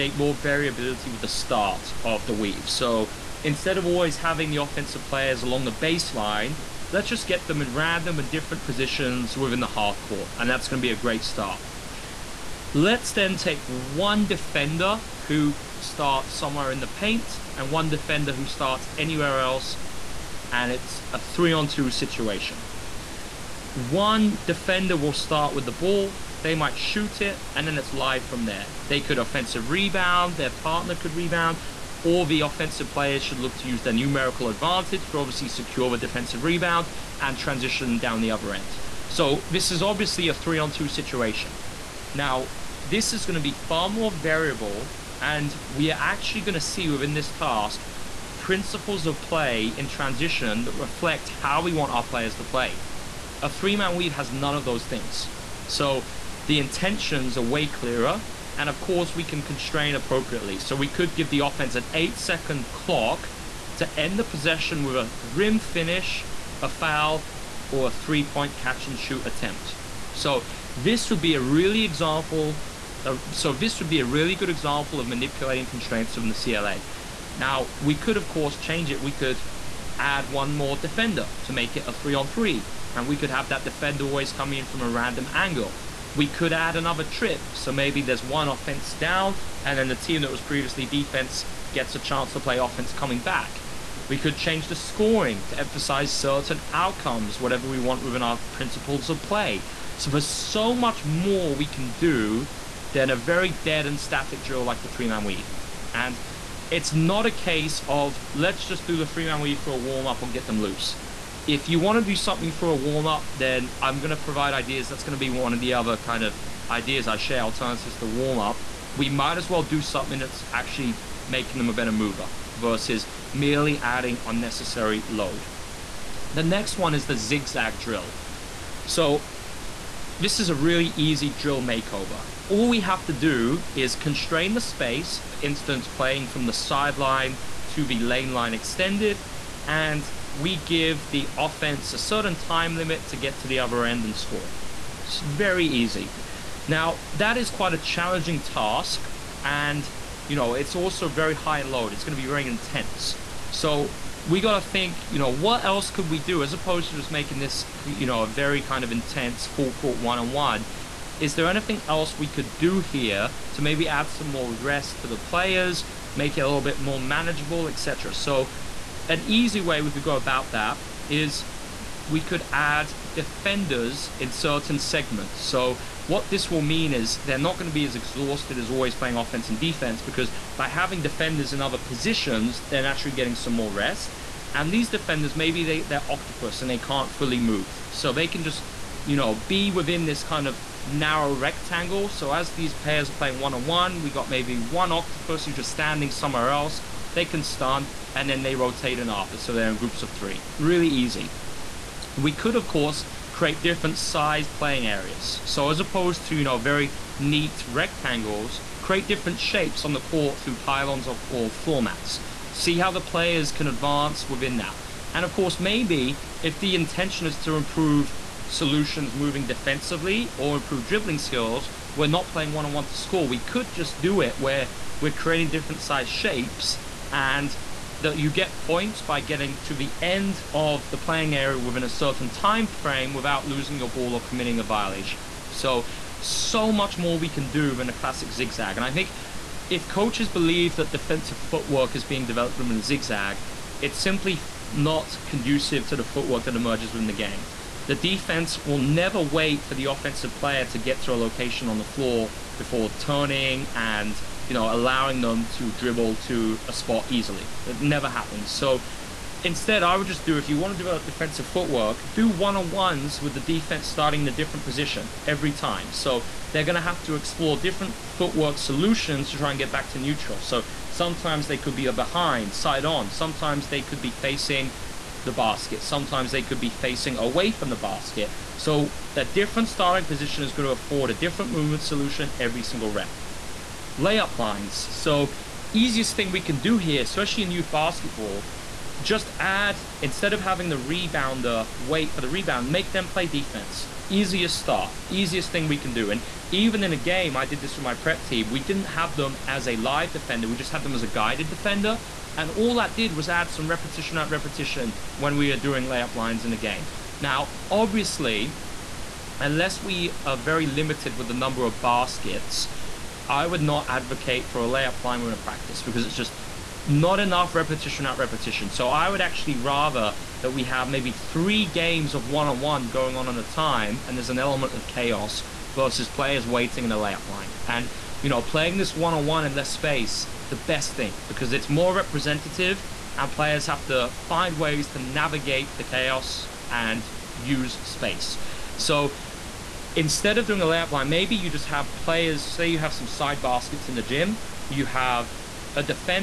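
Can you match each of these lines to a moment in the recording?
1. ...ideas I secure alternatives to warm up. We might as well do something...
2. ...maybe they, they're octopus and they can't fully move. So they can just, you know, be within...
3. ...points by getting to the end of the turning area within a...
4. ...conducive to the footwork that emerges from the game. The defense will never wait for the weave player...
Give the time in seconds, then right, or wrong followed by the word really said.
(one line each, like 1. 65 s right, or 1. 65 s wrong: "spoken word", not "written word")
1. 116 s wrong: "share", not "secure"
2. 185 s right
3. 228 s wrong: "playing", not "turning"
4. 245 s wrong: "offensive", not "weave".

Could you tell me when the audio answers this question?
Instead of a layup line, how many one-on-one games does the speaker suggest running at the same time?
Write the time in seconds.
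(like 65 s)
321 s.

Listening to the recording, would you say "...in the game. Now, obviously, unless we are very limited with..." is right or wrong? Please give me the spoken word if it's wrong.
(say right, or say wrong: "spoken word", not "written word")
right.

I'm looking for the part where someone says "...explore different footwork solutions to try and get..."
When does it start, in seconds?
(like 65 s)
267 s.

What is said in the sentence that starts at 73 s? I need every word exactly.
Of, uh, so this would be a really good example of manipulating constraints from the CLA.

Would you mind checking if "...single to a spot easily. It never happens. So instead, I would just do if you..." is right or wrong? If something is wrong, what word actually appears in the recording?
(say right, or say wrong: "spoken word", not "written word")
wrong: "dribble", not "single".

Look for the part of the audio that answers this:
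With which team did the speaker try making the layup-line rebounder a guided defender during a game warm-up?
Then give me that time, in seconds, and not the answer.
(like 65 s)
297 s.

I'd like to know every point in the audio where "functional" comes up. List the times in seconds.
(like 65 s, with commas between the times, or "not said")
not said.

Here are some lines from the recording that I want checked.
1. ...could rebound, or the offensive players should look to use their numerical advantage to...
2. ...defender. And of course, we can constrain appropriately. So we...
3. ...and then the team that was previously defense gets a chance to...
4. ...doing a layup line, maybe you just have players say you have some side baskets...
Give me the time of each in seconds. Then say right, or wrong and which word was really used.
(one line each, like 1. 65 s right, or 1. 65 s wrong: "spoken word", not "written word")
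1. 30 s right
2. 57 s wrong: "clearer", not "defender"
3. 89 s right
4. 340 s right.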